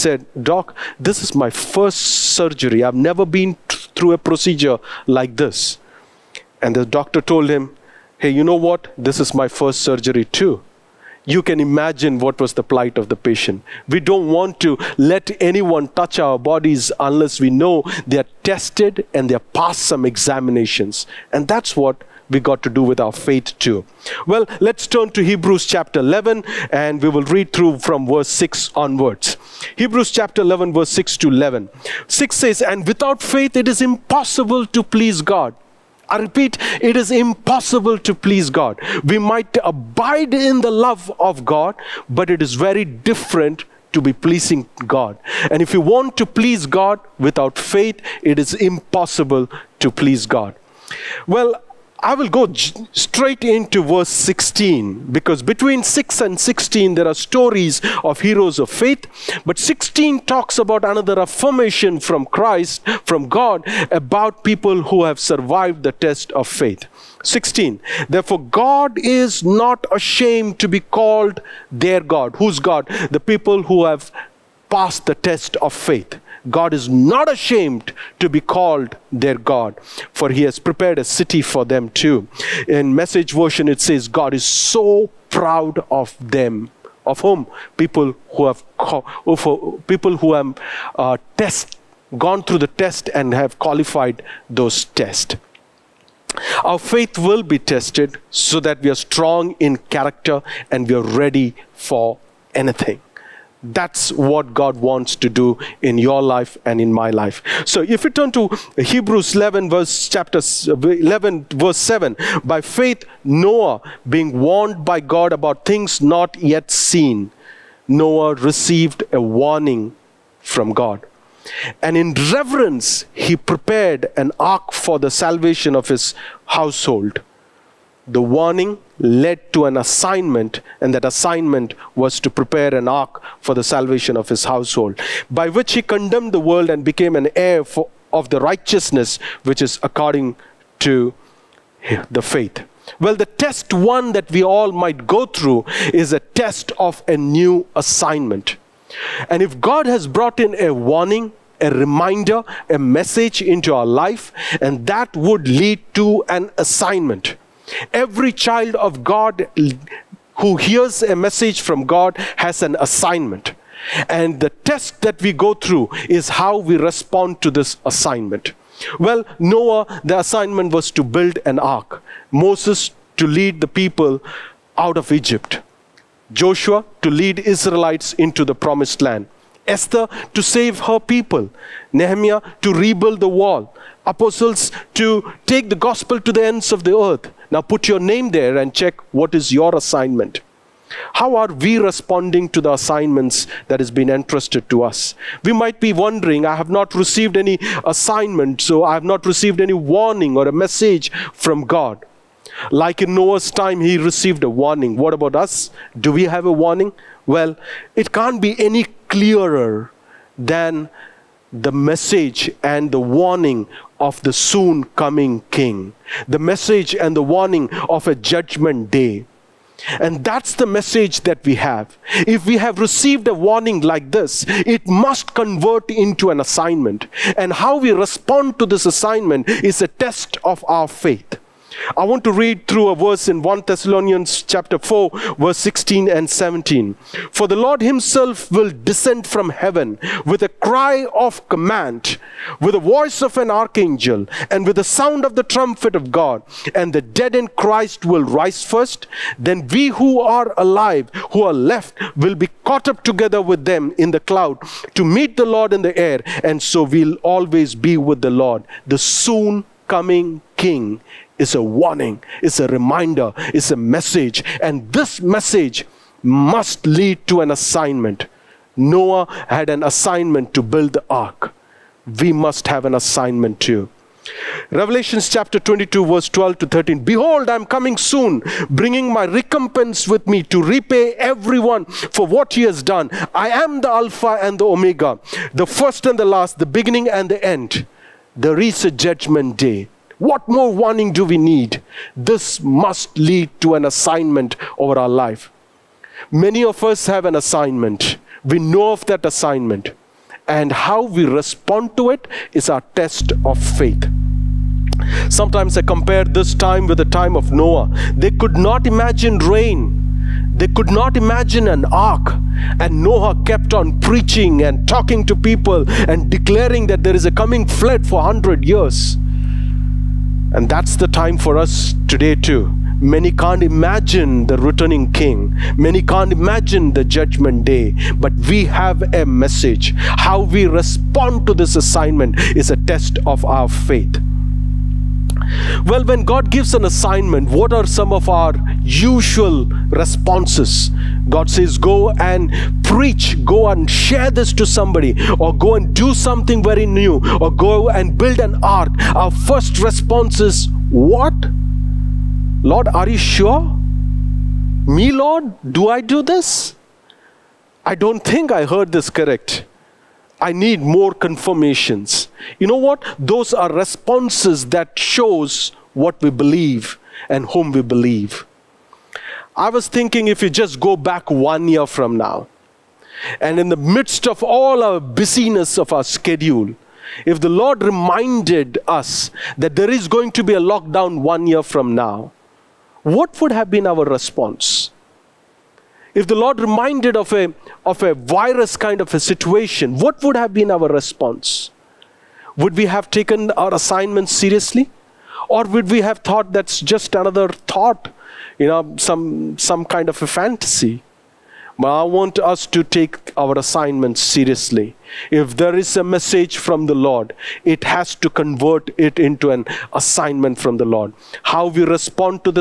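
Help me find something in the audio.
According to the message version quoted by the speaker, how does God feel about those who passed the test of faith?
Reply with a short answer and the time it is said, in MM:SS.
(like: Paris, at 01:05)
so proud of them, at 01:24.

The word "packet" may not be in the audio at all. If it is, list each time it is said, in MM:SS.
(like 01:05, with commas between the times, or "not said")
not said.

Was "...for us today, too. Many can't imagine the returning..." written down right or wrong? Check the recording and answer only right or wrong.
right.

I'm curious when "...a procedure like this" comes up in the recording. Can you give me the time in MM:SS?
00:04.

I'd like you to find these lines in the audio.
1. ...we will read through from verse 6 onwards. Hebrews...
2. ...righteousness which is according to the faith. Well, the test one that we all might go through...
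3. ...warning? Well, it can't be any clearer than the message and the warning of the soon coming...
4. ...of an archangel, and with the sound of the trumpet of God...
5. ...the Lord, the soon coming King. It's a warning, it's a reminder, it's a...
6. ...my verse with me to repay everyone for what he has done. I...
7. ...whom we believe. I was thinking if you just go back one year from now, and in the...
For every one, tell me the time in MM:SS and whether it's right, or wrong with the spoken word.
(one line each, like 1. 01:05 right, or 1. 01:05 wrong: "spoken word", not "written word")
1. 00:27 right
2. 02:18 right
3. 03:26 right
4. 04:03 right
5. 04:18 right
6. 04:39 wrong: "recompense", not "verse"
7. 06:07 right.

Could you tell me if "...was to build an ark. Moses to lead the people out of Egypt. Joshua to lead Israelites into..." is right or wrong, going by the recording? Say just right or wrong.
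right.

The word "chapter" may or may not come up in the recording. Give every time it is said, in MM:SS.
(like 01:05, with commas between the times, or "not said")
00:25, 00:30, 01:50, 03:54, 04:35.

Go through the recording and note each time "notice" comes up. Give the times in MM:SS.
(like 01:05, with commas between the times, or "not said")
not said.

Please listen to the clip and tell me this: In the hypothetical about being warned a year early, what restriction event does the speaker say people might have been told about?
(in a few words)
a lockdown.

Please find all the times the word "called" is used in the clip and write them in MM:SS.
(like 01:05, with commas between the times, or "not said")
01:10, 01:18.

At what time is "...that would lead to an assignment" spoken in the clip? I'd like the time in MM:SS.
02:34.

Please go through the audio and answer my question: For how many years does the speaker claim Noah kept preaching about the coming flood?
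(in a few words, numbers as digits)
100.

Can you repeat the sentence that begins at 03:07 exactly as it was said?
Now put your name there and check what is your assignment.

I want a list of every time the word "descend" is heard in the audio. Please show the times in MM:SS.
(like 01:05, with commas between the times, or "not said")
03:58.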